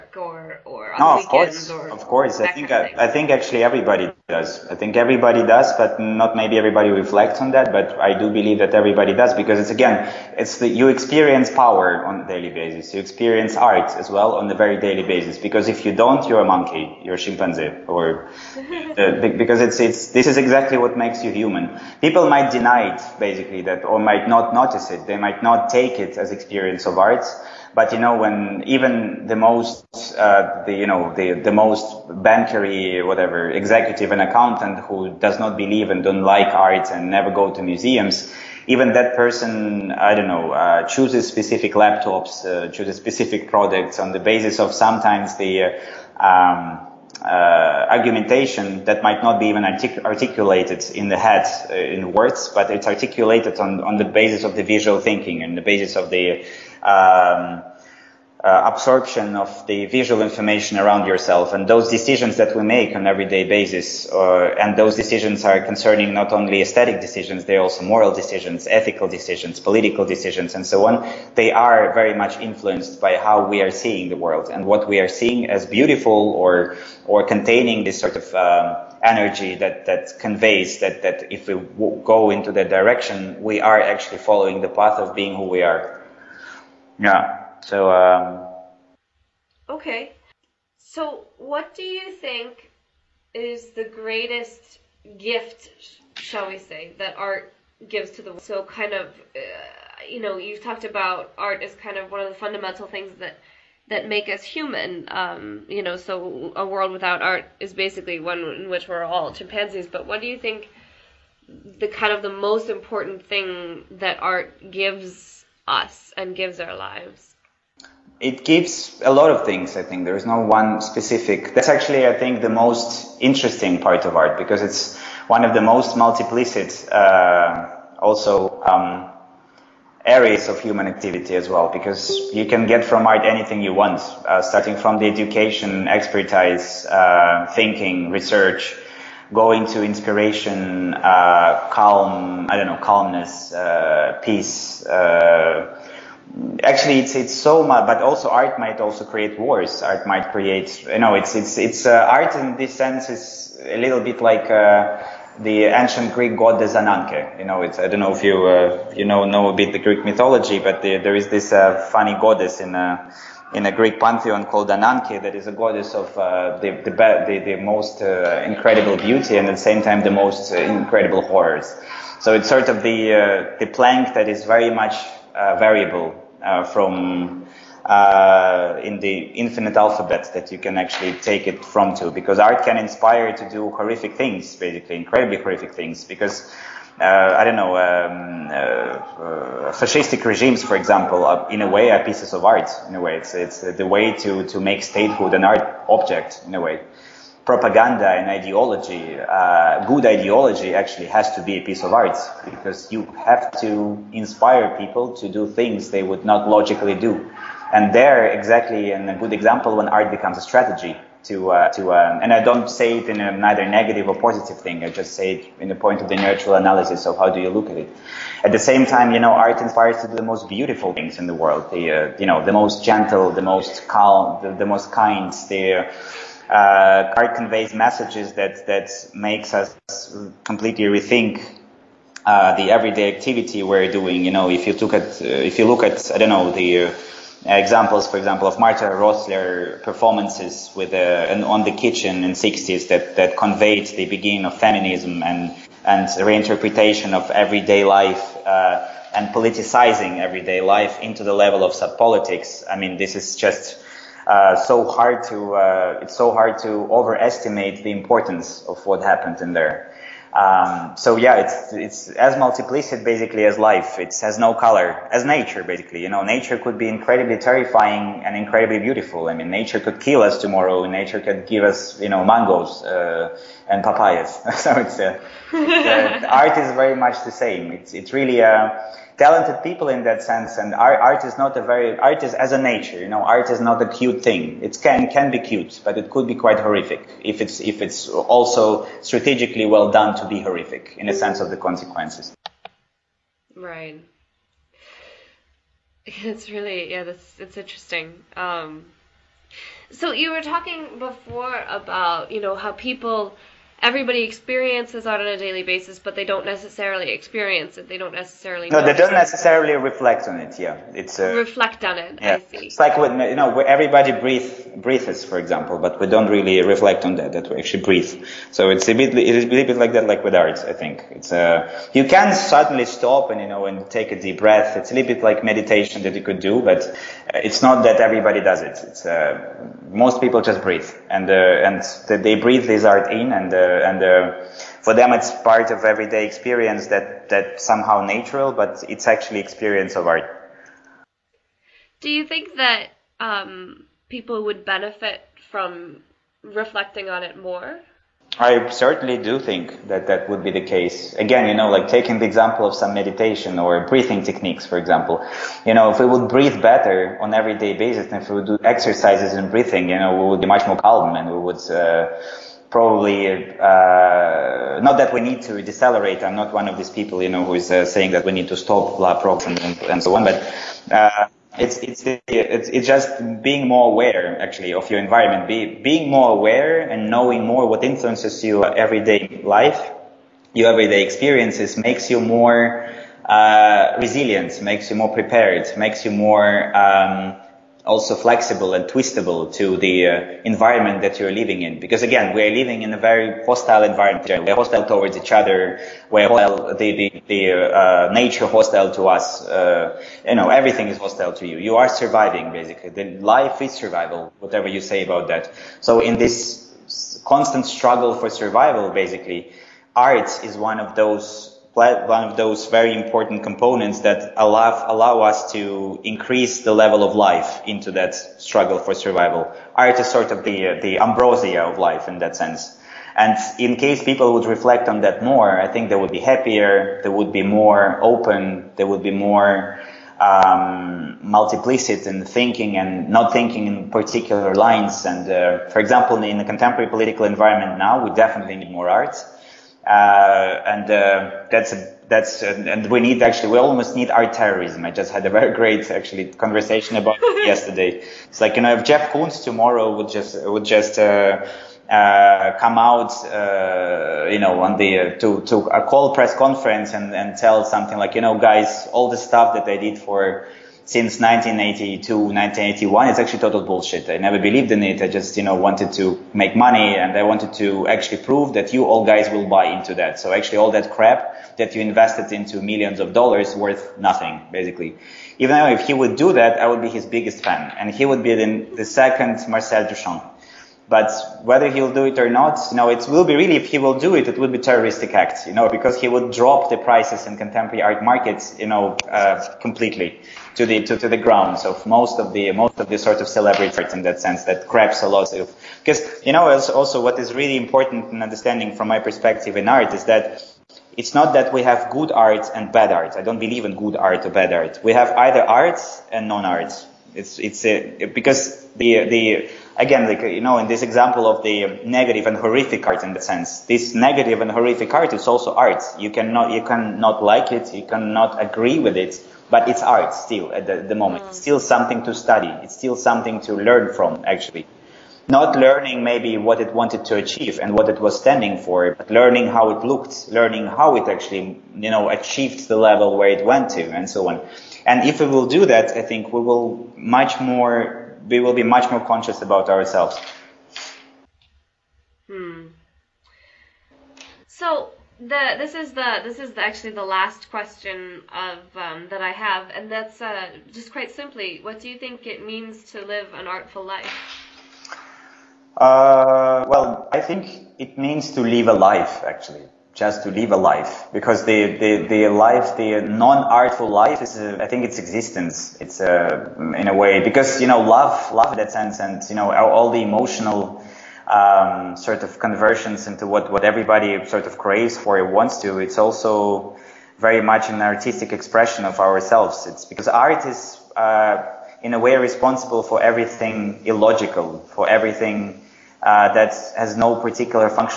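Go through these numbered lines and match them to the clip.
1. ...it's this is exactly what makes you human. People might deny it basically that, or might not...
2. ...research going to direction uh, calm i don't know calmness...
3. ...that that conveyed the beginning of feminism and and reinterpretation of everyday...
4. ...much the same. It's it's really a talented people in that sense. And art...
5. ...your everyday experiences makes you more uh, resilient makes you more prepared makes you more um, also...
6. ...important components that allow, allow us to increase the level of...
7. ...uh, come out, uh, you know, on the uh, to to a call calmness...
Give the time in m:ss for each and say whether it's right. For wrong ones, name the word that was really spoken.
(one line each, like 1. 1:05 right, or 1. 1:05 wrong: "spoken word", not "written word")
1. 0:19 right
2. 2:18 wrong: "inspiration", not "direction"
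3. 4:02 right
4. 4:36 right
5. 6:20 right
6. 6:52 right
7. 7:31 wrong: "press", not "calmness".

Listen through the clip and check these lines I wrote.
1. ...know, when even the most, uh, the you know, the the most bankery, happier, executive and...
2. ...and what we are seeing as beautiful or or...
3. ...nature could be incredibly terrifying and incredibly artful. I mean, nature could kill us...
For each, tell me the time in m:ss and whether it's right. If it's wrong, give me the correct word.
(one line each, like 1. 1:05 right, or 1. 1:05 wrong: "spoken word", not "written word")
1. 0:27 wrong: "whatever", not "happier"
2. 1:14 right
3. 4:26 wrong: "beautiful", not "artful".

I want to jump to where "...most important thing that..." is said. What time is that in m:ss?
1:52.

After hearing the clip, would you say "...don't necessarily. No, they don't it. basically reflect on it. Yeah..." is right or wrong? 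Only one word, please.
wrong.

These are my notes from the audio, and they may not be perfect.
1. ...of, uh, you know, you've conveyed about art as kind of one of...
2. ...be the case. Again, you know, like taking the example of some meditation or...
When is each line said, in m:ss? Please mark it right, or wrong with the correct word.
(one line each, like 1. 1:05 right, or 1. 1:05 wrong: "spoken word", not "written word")
1. 1:38 wrong: "talked", not "conveyed"
2. 5:50 right.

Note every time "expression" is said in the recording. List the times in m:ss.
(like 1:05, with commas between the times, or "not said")
9:38.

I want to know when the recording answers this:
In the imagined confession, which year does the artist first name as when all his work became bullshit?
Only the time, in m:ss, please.
7:41.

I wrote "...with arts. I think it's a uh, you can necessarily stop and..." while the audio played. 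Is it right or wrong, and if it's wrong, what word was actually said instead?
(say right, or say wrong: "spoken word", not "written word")
wrong: "suddenly", not "necessarily".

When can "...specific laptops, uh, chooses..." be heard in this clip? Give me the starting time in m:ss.
0:41.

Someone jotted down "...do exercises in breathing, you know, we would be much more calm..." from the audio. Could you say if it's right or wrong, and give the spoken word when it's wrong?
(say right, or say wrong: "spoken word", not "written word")
right.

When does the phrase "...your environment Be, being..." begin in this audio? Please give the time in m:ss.
6:14.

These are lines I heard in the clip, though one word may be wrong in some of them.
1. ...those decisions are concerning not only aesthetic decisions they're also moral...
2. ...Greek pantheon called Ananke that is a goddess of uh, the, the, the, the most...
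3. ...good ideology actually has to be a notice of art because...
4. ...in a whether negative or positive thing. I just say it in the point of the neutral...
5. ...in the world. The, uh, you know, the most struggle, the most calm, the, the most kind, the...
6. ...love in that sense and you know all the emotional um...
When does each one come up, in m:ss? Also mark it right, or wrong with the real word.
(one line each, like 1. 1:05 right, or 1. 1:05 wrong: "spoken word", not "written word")
1. 1:04 right
2. 2:43 right
3. 3:19 wrong: "piece", not "notice"
4. 3:33 wrong: "neither", not "whether"
5. 3:41 wrong: "gentle", not "struggle"
6. 9:28 right.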